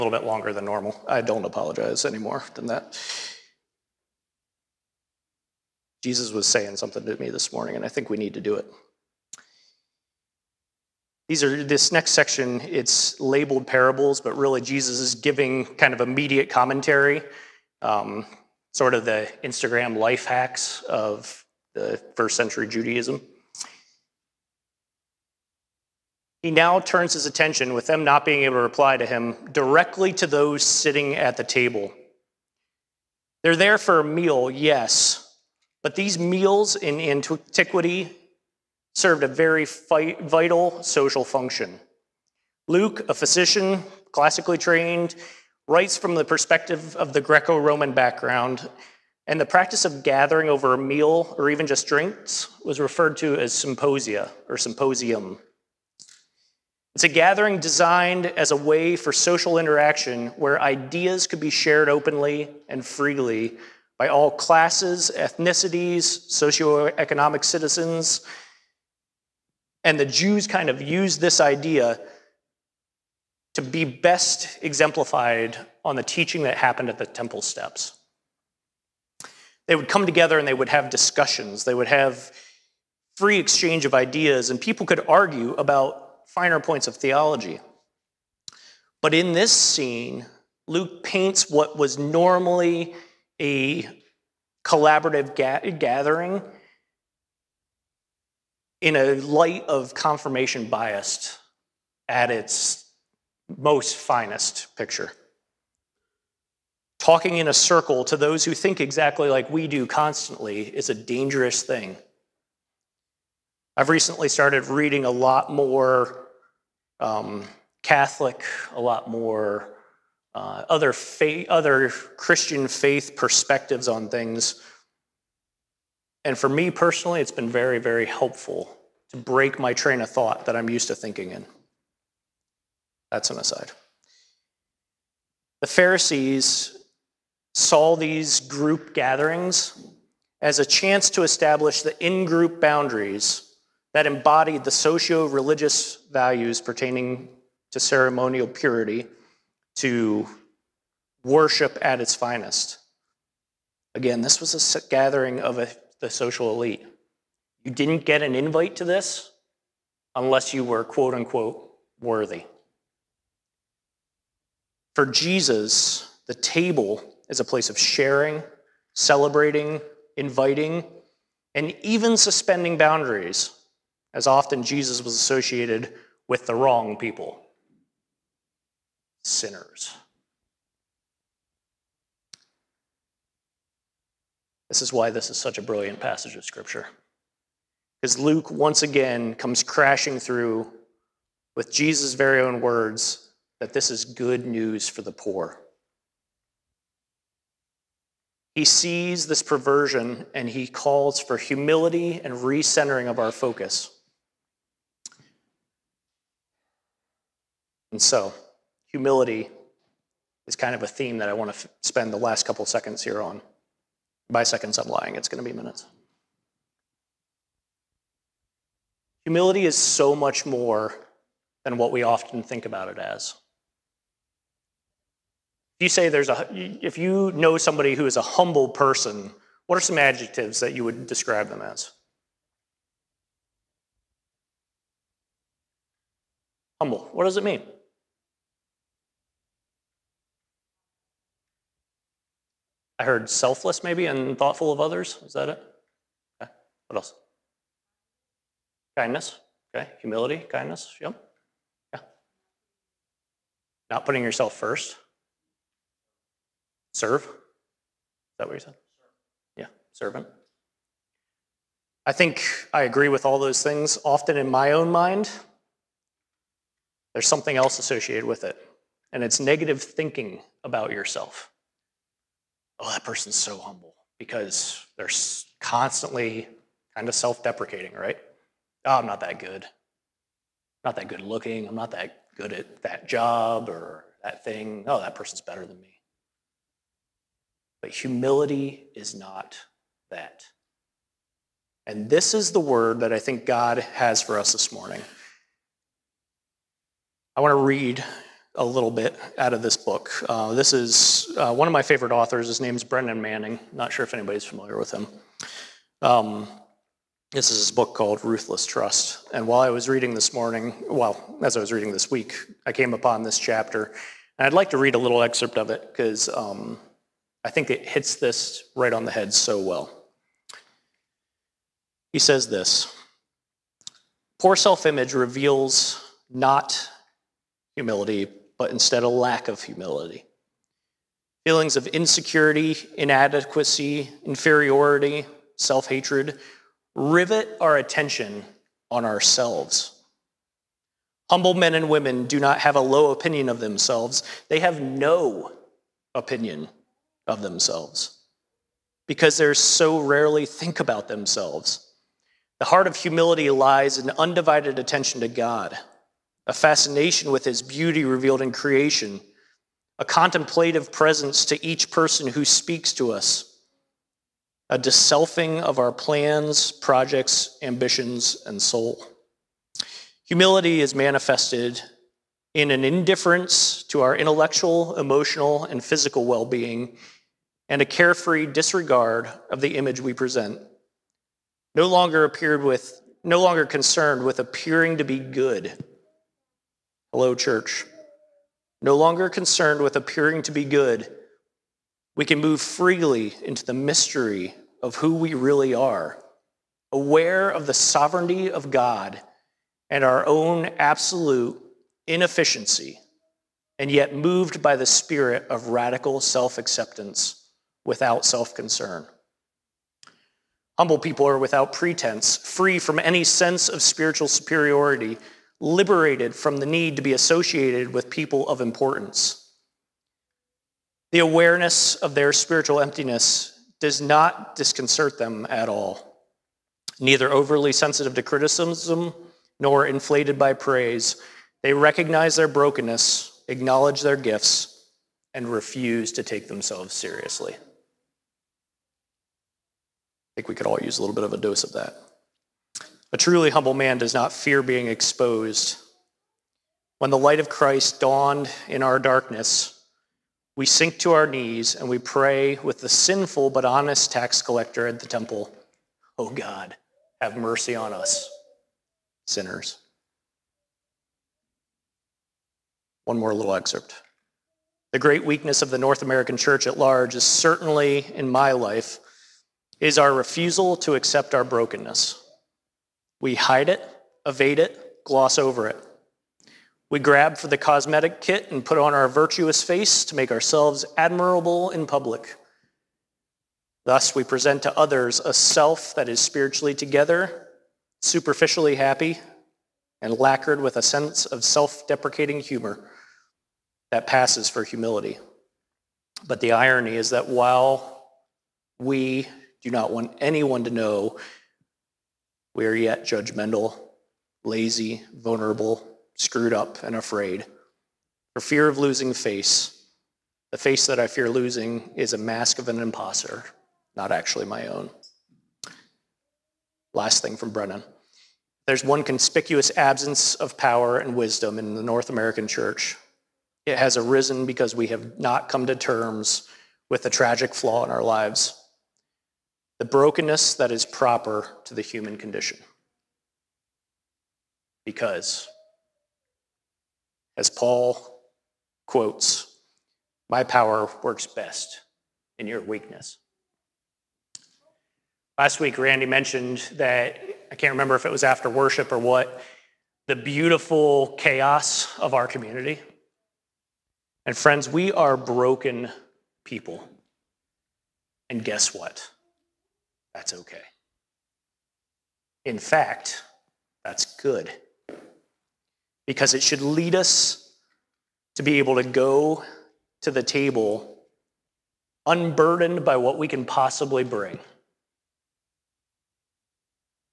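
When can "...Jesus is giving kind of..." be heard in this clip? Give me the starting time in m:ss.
0:14.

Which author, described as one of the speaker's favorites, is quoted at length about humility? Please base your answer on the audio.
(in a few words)
Brennan Manning.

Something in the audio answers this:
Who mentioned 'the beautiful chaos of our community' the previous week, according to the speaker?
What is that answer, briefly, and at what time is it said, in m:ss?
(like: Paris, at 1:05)
Randy, at 9:05.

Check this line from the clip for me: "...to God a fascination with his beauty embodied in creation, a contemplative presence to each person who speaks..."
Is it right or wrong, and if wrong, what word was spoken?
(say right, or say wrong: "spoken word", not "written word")
wrong: "revealed", not "embodied".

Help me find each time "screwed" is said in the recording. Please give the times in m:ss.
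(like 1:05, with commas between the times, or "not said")
8:26.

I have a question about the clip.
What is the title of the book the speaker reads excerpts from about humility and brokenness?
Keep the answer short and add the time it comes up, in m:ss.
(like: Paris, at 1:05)
Ruthless Trust, at 5:08.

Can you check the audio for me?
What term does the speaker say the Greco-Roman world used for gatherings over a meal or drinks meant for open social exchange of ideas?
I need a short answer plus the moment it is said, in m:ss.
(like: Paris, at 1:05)
symposia, at 0:53.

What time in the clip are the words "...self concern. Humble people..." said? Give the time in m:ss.
6:48.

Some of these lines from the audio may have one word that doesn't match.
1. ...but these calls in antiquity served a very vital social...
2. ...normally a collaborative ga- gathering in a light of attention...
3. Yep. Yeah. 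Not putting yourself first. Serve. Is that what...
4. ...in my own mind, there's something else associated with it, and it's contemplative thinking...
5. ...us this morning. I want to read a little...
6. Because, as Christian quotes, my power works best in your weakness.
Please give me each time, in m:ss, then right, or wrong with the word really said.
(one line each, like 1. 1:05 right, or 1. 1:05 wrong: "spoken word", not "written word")
1. 0:35 wrong: "meals", not "calls"
2. 1:31 wrong: "confirmation", not "attention"
3. 4:10 right
4. 4:24 wrong: "negative", not "contemplative"
5. 4:54 right
6. 8:54 wrong: "Paul", not "Christian".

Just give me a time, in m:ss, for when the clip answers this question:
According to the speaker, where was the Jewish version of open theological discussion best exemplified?
1:17.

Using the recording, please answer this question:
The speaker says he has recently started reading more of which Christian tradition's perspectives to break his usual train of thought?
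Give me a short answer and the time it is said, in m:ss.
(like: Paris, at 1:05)
Catholic, at 1:57.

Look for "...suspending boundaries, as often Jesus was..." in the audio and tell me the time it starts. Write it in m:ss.
2:52.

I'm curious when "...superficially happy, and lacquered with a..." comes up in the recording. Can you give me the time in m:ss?
8:08.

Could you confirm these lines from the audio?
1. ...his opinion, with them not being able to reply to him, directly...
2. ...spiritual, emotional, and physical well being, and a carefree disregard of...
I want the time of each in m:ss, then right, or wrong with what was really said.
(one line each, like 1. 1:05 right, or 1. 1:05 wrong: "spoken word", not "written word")
1. 0:27 wrong: "attention", not "opinion"
2. 6:14 wrong: "intellectual", not "spiritual".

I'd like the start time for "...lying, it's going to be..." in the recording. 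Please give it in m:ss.
3:34.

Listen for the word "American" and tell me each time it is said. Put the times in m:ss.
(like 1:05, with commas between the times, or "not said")
7:46, 8:42.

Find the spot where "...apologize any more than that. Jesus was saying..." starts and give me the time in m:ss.
0:01.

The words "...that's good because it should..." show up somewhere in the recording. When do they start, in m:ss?
9:23.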